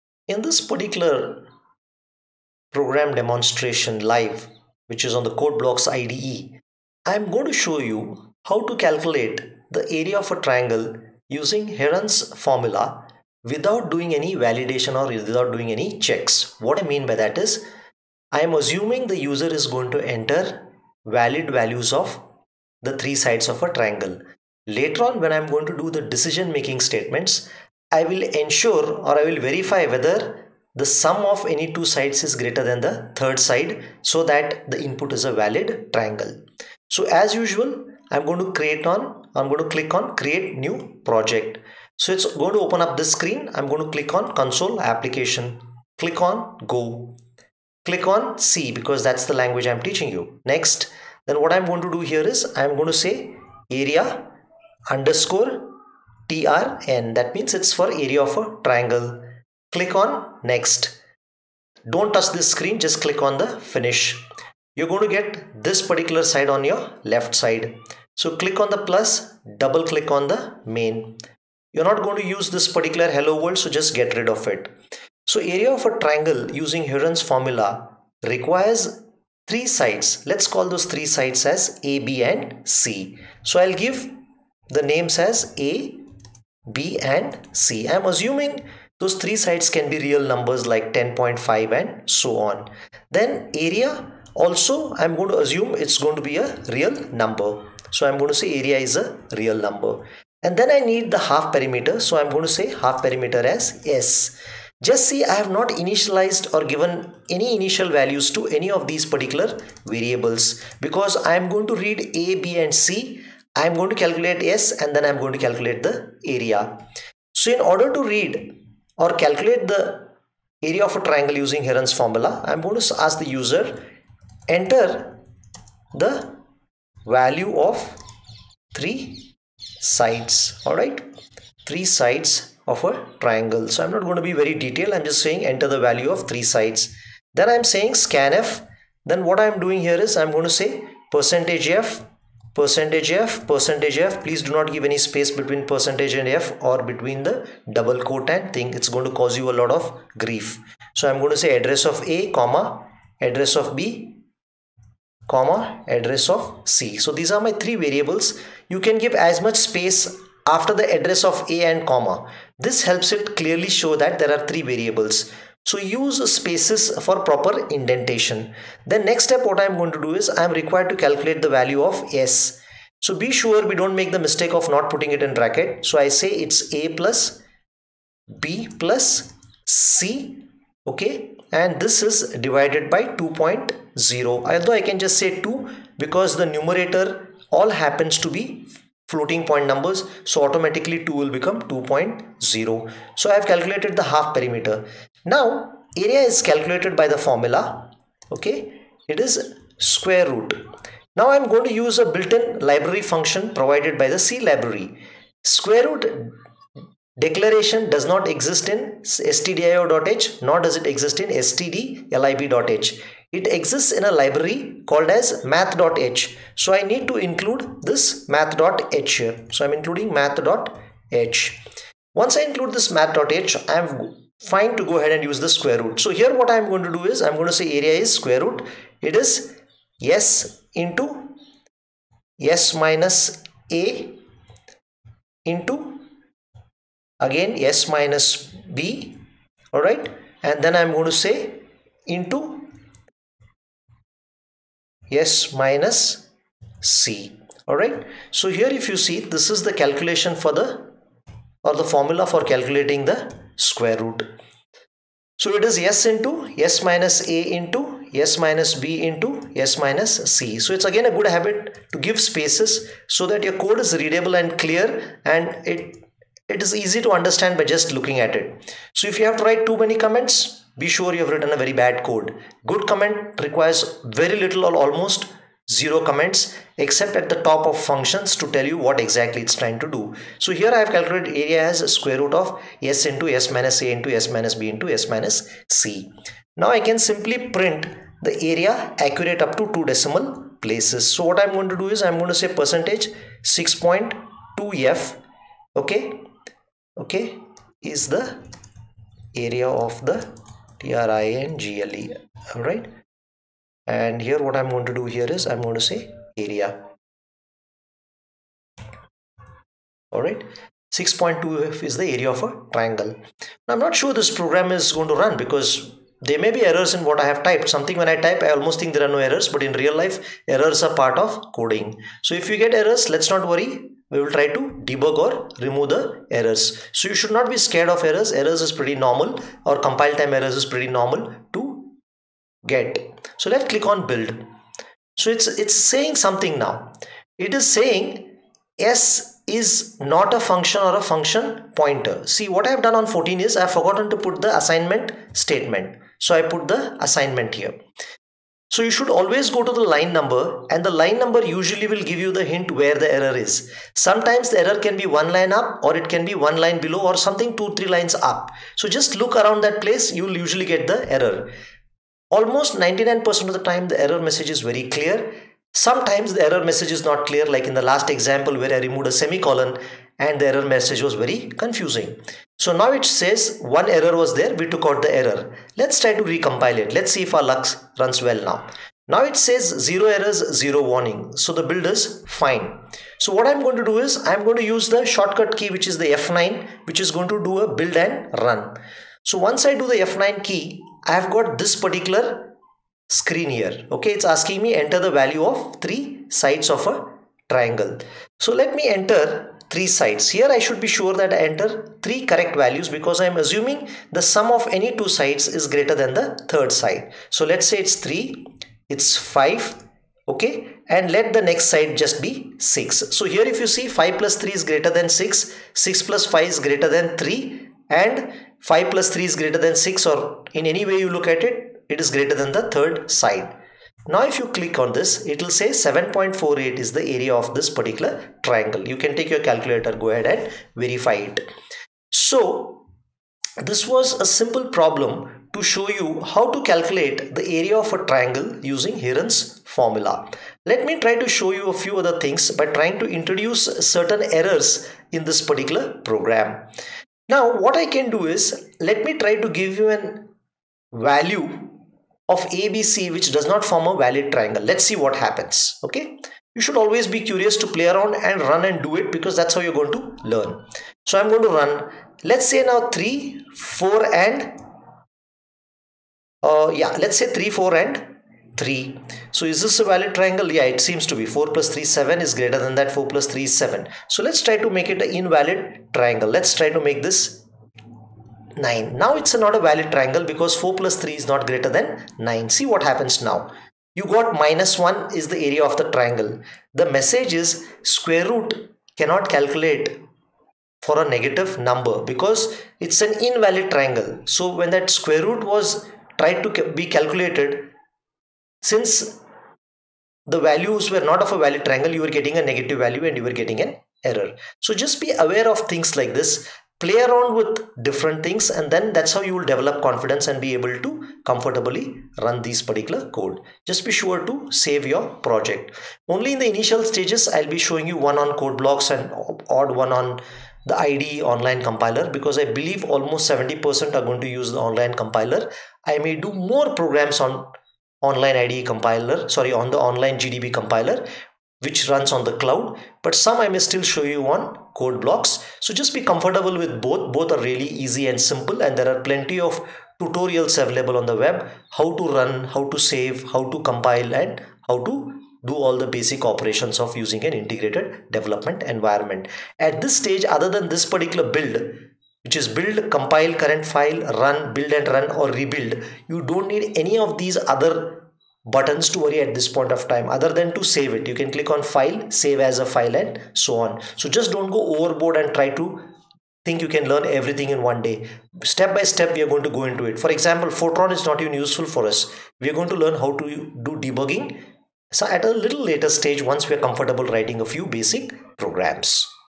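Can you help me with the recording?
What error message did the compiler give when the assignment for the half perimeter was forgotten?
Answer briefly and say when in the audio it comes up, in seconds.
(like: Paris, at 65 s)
S is not a function or a function pointer, at 338 s.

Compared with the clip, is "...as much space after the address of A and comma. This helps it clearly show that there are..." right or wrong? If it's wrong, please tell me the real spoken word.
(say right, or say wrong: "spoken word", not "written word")
right.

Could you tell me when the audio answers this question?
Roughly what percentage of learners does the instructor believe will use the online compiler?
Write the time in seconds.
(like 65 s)
523 s.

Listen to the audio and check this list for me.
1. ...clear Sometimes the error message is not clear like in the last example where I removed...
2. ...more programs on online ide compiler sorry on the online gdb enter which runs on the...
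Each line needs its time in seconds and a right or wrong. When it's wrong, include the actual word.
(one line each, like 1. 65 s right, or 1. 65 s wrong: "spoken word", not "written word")
1. 364 s right
2. 526 s wrong: "compiler", not "enter".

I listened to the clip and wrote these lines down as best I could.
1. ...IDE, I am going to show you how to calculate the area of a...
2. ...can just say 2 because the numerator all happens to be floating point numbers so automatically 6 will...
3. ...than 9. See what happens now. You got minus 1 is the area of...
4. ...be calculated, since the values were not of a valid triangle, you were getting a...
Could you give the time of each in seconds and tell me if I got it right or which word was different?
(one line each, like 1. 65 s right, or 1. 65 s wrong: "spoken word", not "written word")
1. 5 s right
2. 184 s wrong: "2", not "6"
3. 481 s right
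4. 496 s right.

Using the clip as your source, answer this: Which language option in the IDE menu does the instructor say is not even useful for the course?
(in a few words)
Fortran.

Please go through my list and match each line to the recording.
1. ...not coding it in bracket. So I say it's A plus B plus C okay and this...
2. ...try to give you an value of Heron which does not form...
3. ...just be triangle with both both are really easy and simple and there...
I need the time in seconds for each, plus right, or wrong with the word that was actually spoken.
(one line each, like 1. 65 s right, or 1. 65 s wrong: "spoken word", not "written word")
1. 174 s wrong: "putting", not "coding"
2. 449 s wrong: "ABC", not "Heron"
3. 535 s wrong: "comfortable", not "triangle".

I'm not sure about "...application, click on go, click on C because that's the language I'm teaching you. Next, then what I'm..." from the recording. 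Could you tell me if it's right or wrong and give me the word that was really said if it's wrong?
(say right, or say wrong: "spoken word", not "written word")
right.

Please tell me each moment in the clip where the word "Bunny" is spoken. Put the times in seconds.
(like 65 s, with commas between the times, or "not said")
not said.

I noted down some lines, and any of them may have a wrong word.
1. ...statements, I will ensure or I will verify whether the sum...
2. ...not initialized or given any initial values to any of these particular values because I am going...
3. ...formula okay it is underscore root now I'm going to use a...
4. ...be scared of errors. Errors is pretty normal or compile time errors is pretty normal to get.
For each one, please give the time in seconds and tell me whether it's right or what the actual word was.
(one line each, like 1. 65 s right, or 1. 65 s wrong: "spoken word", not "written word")
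1. 26 s right
2. 105 s wrong: "variables", not "values"
3. 197 s wrong: "square", not "underscore"
4. 327 s right.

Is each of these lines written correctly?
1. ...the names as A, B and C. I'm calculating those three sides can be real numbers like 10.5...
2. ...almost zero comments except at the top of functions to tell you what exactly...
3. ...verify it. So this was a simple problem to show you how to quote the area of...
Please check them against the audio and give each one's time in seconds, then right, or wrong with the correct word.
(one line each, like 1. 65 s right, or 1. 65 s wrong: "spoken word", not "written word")
1. 84 s wrong: "assuming", not "calculating"
2. 274 s right
3. 430 s wrong: "calculate", not "quote".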